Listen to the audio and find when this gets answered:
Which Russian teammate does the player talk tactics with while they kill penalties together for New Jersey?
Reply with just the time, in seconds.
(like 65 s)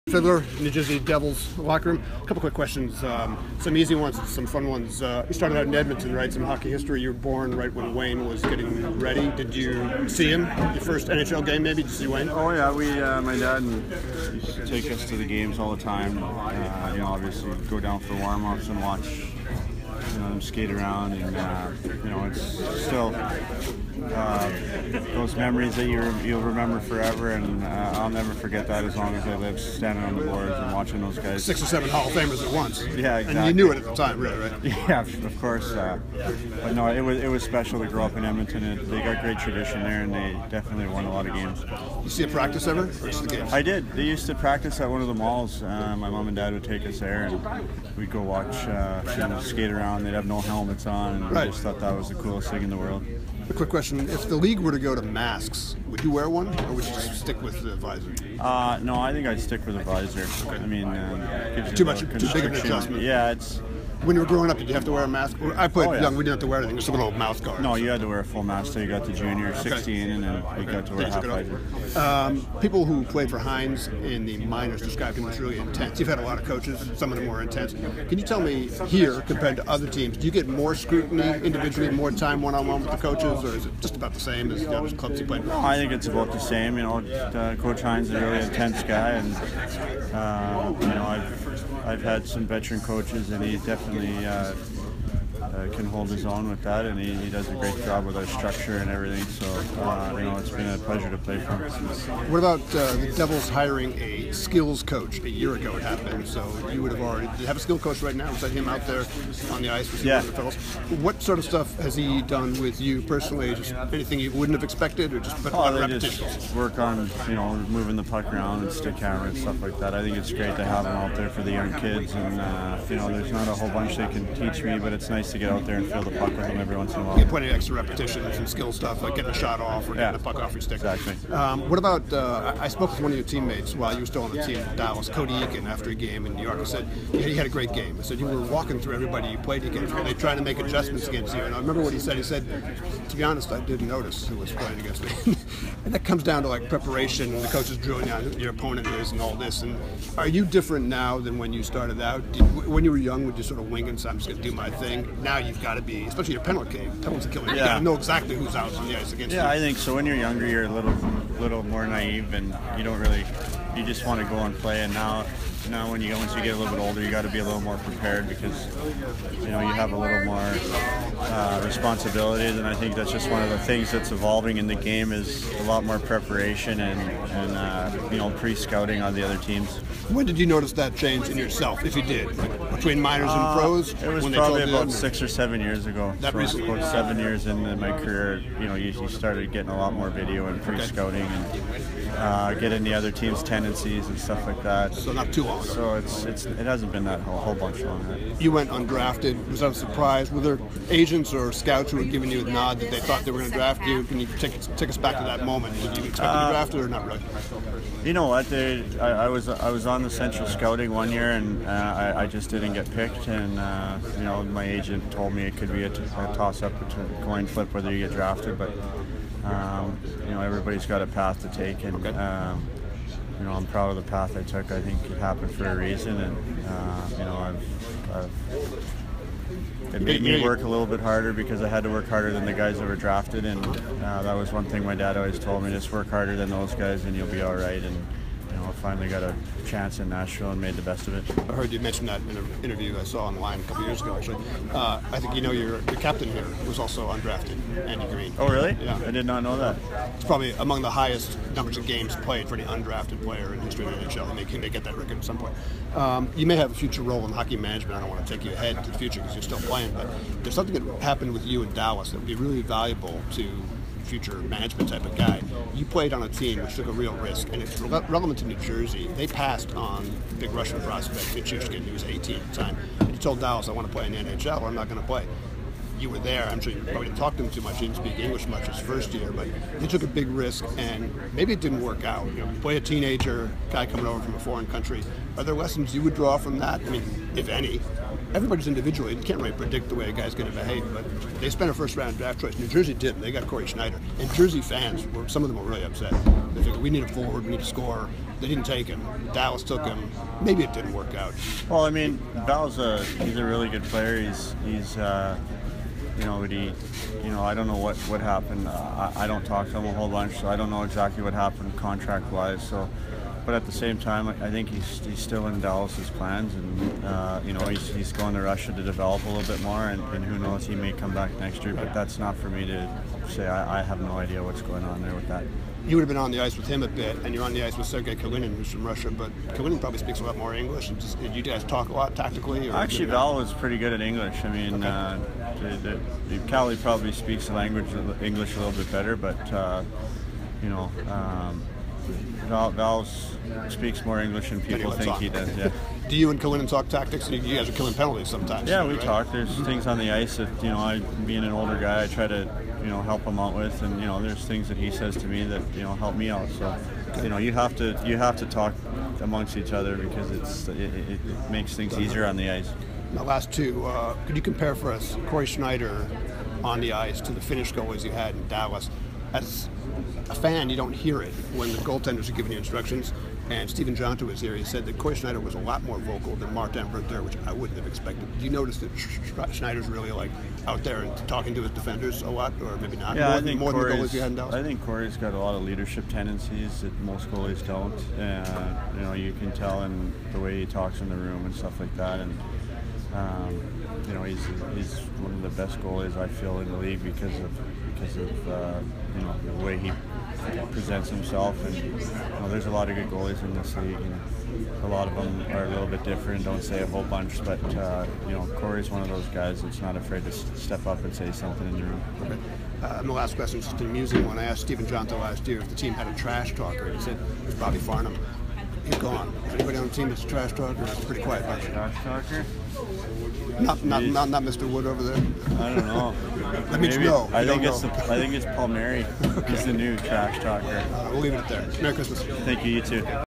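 327 s.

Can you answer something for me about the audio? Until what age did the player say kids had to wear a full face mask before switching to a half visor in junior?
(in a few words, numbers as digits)
16.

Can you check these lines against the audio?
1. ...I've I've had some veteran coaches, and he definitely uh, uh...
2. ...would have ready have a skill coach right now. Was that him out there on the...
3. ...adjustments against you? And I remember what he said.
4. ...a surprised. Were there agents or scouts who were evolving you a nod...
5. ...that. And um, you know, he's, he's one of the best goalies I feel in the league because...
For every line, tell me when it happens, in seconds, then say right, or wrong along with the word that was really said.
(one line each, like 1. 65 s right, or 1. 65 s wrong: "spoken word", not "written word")
1. 91 s right
2. 106 s wrong: "already", not "ready"
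3. 140 s right
4. 199 s wrong: "giving", not "evolving"
5. 391 s right.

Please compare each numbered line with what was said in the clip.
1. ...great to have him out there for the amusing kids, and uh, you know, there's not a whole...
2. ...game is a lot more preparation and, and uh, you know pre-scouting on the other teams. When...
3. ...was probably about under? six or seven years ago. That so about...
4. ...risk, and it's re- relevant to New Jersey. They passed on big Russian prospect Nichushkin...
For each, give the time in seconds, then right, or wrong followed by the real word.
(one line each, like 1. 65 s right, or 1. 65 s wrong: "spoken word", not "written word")
1. 120 s wrong: "young", not "amusing"
2. 174 s right
3. 184 s right
4. 267 s right.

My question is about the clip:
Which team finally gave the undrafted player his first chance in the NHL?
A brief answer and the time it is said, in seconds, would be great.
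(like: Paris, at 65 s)
Nashville, at 240 s.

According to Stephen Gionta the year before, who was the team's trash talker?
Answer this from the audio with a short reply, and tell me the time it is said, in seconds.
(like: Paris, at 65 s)
Bobby Farnham, at 417 s.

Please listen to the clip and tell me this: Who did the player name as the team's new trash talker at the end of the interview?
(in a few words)
Palmieri.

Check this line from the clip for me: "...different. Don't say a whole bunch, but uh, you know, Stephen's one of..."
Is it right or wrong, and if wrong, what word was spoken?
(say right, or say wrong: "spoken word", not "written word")
wrong: "Cory", not "Stephen".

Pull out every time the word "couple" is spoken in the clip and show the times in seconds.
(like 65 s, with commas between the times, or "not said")
2 s, 243 s.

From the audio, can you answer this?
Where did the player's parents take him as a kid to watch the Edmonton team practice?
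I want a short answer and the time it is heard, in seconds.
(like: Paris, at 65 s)
One of the malls, at 44 s.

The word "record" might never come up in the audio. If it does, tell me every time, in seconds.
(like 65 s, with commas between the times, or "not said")
254 s.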